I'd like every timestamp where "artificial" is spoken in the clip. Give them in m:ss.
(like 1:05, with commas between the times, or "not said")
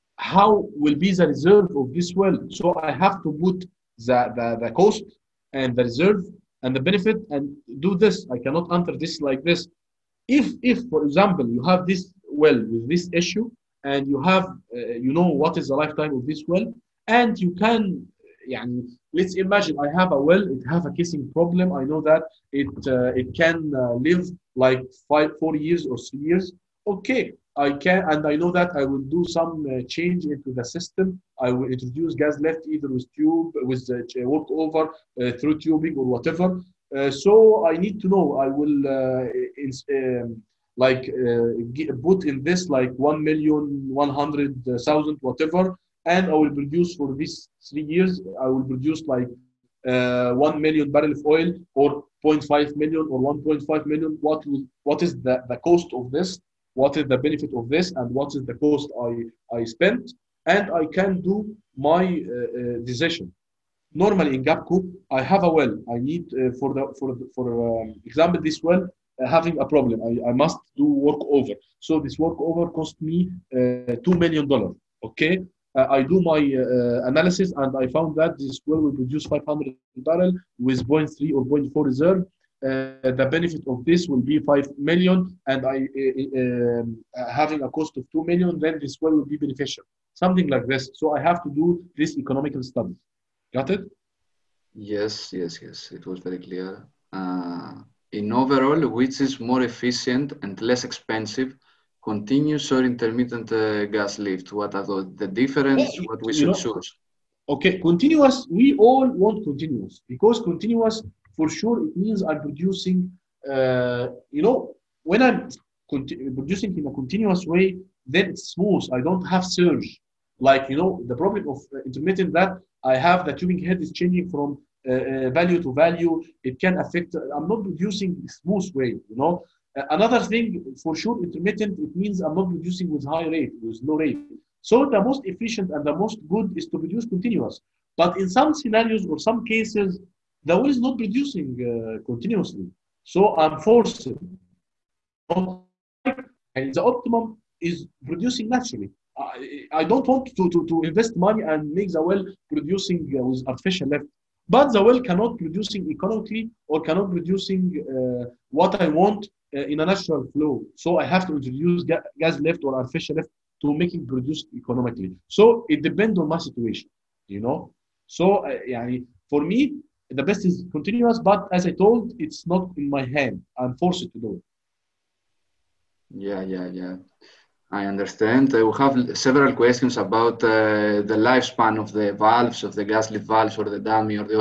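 2:33, 2:42.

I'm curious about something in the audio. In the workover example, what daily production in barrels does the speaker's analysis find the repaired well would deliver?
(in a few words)
500 barrels.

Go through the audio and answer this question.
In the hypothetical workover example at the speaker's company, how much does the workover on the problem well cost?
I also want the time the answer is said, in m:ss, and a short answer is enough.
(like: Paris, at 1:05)
$2 million, at 1:14.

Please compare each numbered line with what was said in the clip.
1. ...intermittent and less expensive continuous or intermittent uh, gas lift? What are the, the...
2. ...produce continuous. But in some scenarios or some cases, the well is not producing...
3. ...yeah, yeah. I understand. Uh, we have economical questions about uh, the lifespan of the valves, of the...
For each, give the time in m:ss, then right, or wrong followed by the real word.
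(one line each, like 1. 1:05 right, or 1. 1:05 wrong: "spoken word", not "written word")
1. 1:39 wrong: "efficient", not "intermittent"
2. 2:16 right
3. 2:56 wrong: "several", not "economical".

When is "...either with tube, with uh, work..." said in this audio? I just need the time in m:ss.
0:32.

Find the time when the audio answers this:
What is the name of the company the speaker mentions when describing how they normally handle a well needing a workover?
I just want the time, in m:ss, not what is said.
1:04.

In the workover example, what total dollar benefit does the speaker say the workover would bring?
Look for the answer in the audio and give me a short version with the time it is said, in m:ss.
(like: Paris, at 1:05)
$5 million, at 1:24.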